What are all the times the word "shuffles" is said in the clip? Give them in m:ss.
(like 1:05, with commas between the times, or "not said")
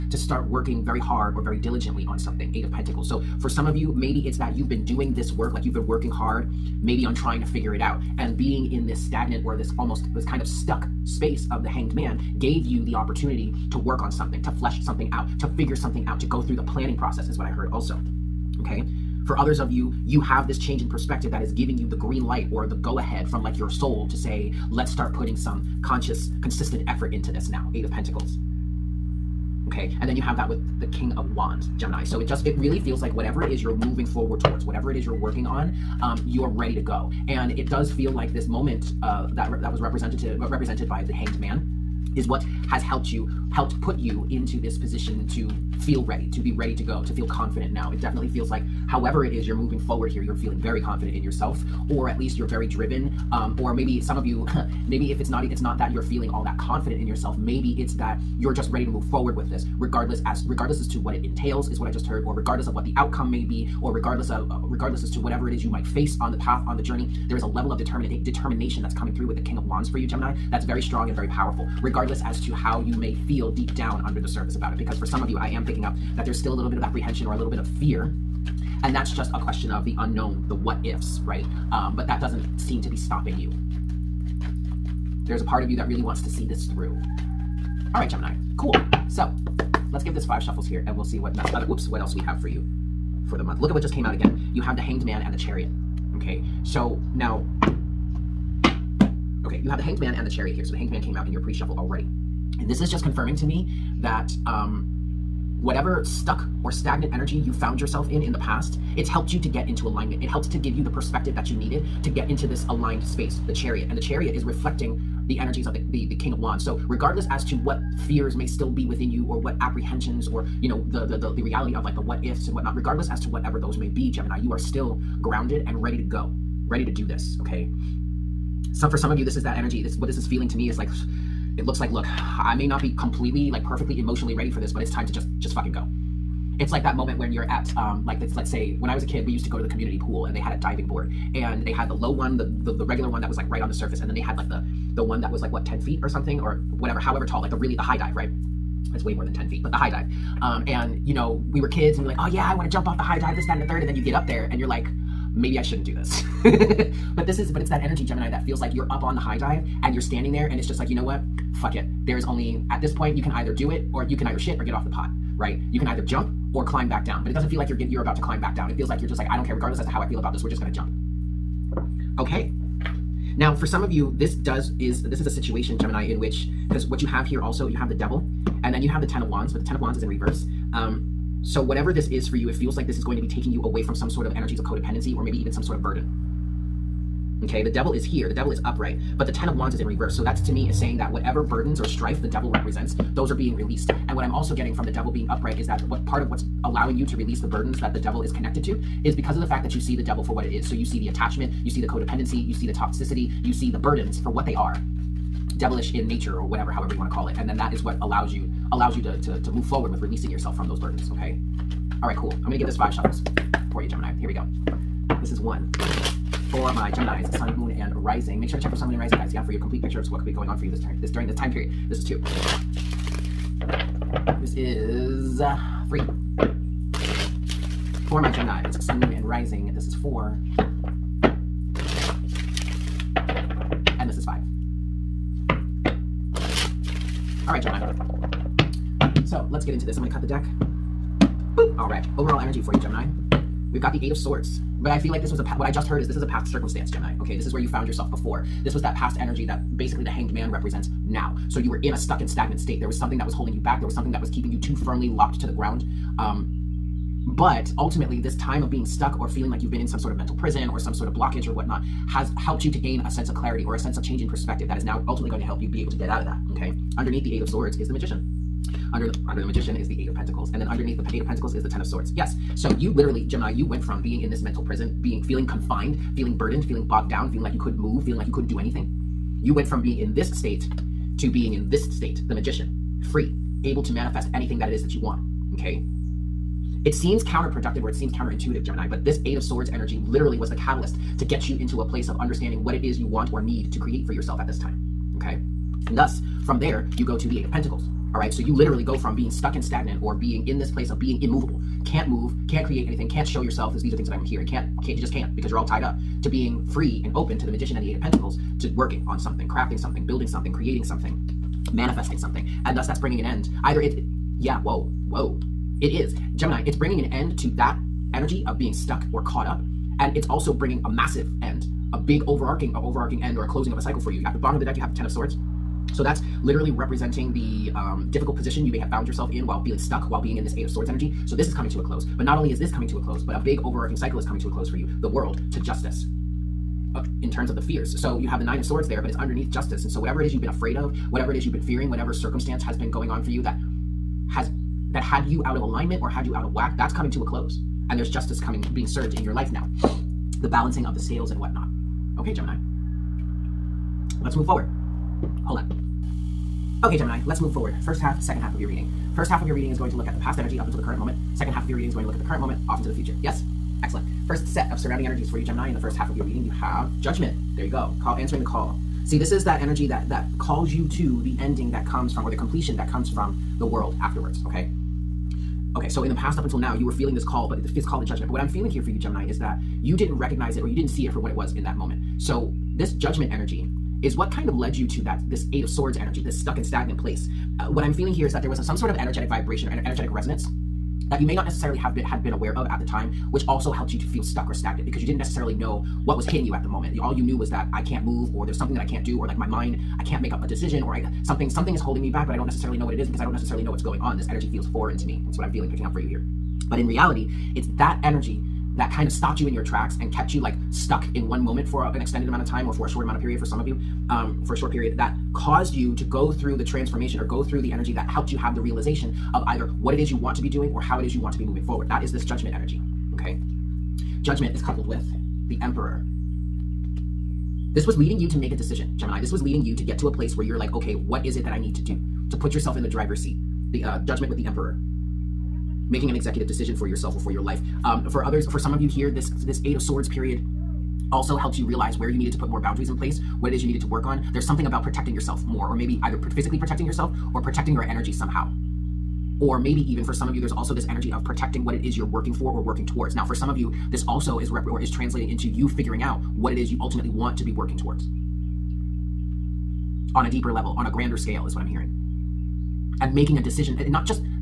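1:30, 1:41, 3:32.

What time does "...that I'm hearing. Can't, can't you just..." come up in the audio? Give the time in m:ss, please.
5:04.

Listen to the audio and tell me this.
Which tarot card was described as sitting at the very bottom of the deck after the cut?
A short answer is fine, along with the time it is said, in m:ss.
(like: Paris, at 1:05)
Ten of Swords, at 5:24.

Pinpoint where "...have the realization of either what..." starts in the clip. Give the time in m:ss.
6:58.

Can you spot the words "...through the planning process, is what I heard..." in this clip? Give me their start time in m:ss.
0:16.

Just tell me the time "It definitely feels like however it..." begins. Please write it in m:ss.
0:47.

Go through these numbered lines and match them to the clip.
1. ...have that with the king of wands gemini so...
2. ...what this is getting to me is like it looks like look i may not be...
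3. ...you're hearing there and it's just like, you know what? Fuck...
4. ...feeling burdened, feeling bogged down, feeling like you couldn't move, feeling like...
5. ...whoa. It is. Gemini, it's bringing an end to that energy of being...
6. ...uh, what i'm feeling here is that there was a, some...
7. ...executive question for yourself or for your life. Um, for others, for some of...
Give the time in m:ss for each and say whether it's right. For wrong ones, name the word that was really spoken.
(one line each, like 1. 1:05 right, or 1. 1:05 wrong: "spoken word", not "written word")
1. 0:30 right
2. 2:09 wrong: "feeling", not "getting"
3. 2:39 wrong: "standing", not "hearing"
4. 4:36 right
5. 5:15 right
6. 6:27 right
7. 7:16 wrong: "decision", not "question".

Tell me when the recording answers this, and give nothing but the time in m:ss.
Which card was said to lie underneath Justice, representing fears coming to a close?
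5:38.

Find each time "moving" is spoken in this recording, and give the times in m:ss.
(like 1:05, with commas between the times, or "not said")
0:33, 0:49, 7:01.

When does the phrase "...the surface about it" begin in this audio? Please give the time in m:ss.
1:14.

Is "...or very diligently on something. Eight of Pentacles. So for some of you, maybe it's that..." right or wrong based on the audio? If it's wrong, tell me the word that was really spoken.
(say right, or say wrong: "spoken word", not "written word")
right.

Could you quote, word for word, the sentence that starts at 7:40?
On a deeper level, on a grander scale, is what I'm hearing.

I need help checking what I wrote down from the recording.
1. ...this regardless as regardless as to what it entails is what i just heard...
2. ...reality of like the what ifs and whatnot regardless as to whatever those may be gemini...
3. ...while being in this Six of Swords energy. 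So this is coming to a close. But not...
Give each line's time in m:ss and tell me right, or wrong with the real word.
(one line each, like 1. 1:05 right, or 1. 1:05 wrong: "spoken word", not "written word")
1. 0:59 right
2. 2:01 right
3. 5:30 wrong: "Eight", not "Six".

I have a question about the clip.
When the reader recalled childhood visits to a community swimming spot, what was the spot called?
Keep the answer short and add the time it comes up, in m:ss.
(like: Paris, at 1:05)
community pool, at 2:19.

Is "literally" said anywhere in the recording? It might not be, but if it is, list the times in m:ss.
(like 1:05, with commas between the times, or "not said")
4:32, 4:50, 4:58, 5:26.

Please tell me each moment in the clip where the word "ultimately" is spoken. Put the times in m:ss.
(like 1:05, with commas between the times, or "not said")
4:17, 4:25, 7:36.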